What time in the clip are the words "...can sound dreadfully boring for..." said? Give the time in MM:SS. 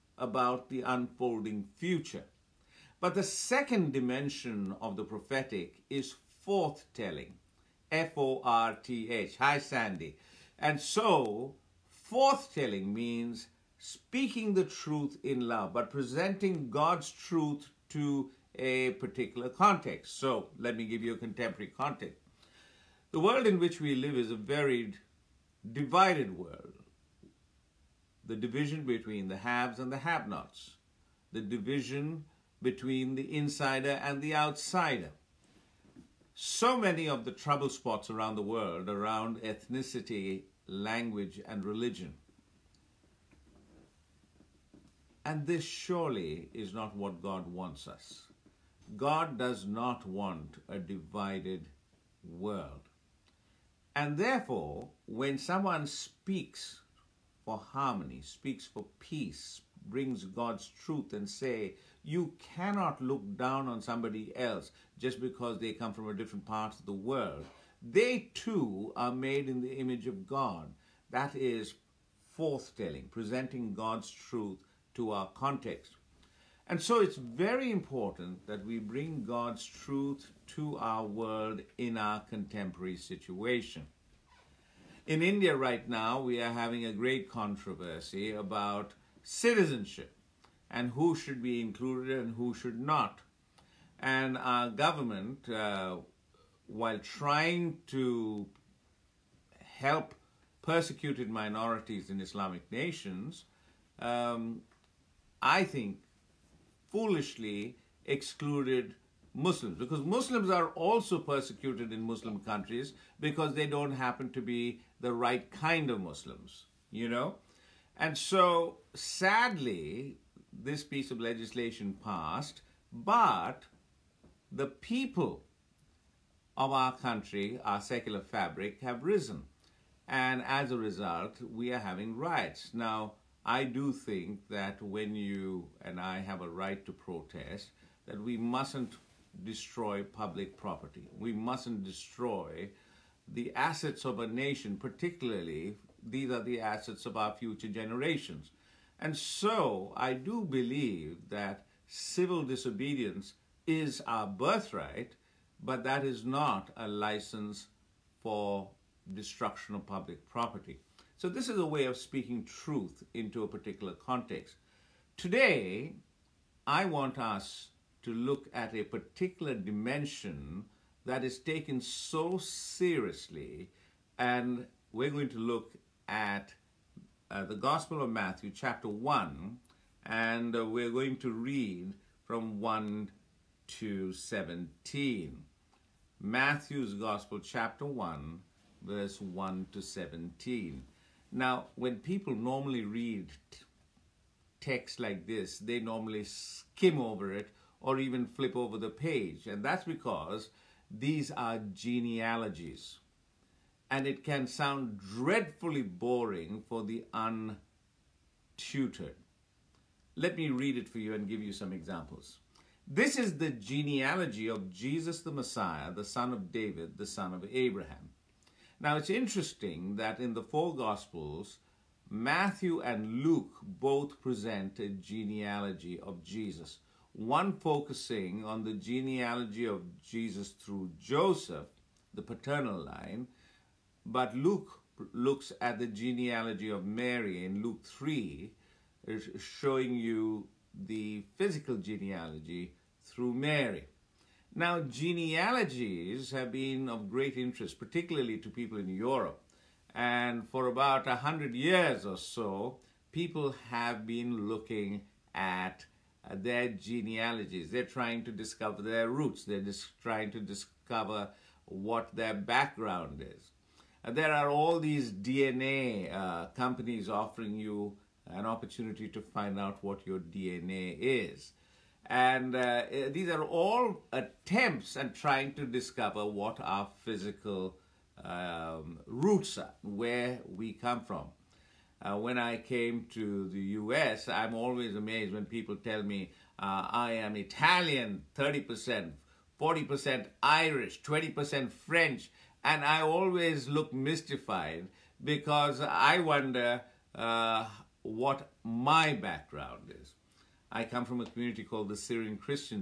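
03:24.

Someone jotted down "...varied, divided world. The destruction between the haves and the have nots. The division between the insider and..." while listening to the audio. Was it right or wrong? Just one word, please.
wrong.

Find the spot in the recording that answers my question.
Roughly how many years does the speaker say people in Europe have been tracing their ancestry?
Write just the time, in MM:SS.
04:11.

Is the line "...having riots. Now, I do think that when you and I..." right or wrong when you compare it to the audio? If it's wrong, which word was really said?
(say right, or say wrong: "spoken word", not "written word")
right.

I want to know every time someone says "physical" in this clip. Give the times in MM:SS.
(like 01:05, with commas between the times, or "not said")
04:01, 04:37.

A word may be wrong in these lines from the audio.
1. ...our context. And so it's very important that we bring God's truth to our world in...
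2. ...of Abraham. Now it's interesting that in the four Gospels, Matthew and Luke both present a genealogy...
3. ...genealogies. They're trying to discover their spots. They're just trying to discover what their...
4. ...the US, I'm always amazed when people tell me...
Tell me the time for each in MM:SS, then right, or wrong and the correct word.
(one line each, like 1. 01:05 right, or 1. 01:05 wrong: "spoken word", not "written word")
1. 01:15 right
2. 03:37 right
3. 04:16 wrong: "roots", not "spots"
4. 04:43 right.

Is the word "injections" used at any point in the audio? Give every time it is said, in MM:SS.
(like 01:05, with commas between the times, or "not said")
not said.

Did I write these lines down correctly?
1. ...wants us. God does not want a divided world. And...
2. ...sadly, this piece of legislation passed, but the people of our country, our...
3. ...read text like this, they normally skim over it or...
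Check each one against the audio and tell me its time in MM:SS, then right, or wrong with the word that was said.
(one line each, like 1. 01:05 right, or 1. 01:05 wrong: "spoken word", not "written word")
1. 00:47 right
2. 01:58 right
3. 03:12 right.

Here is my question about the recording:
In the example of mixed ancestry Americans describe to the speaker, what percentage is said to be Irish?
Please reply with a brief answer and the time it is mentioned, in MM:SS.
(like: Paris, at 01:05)
40%, at 04:49.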